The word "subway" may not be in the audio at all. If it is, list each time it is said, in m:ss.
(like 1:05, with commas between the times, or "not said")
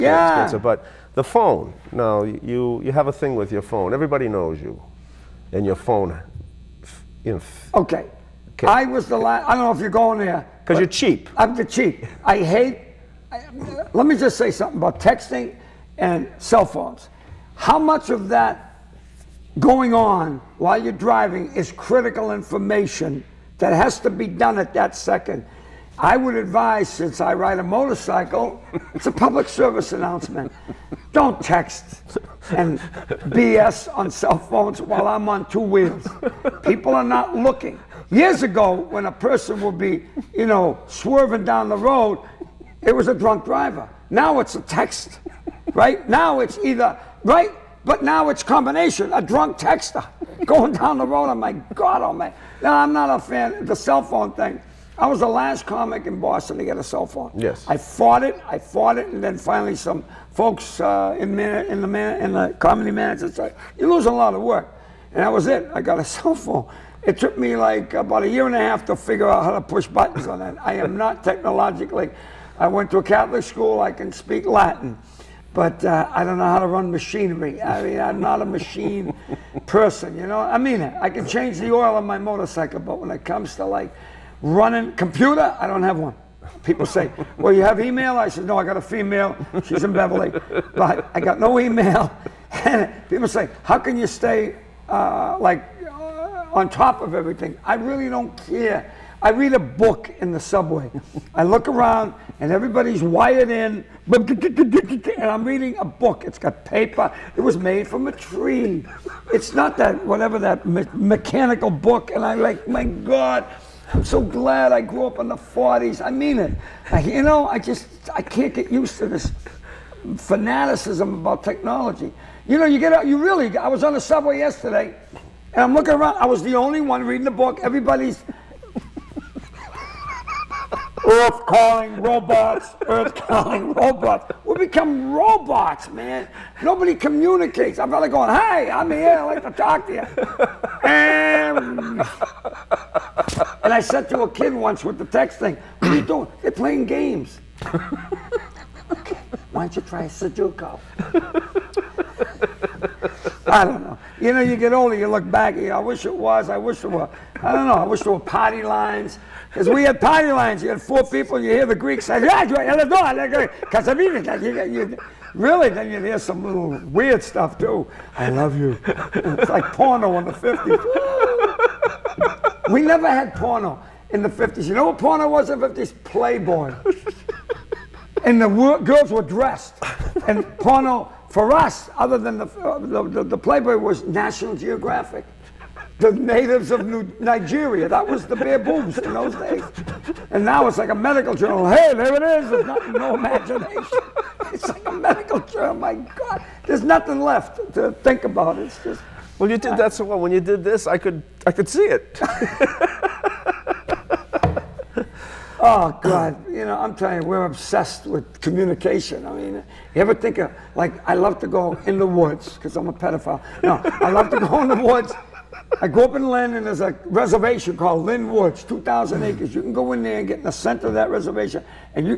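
1:40, 2:04.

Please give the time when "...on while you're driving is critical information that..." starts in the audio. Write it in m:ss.
0:19.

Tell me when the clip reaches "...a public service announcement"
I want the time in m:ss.
0:29.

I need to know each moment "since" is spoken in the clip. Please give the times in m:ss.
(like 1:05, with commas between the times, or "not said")
0:26.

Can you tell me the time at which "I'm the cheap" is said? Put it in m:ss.
0:11.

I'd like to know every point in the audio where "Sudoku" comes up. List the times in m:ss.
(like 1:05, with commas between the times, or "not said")
2:30.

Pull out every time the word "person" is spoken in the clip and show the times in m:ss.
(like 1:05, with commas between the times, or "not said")
0:39, 1:19.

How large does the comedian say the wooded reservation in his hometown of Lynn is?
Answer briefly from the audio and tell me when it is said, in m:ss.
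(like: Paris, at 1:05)
2,000 acres, at 3:38.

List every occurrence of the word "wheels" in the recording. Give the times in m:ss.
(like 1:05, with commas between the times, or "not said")
0:35.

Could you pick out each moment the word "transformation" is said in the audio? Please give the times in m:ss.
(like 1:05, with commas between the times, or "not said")
not said.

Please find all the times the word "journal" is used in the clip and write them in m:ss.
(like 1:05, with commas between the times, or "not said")
3:11, 3:15.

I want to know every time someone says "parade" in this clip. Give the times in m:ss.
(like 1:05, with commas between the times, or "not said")
not said.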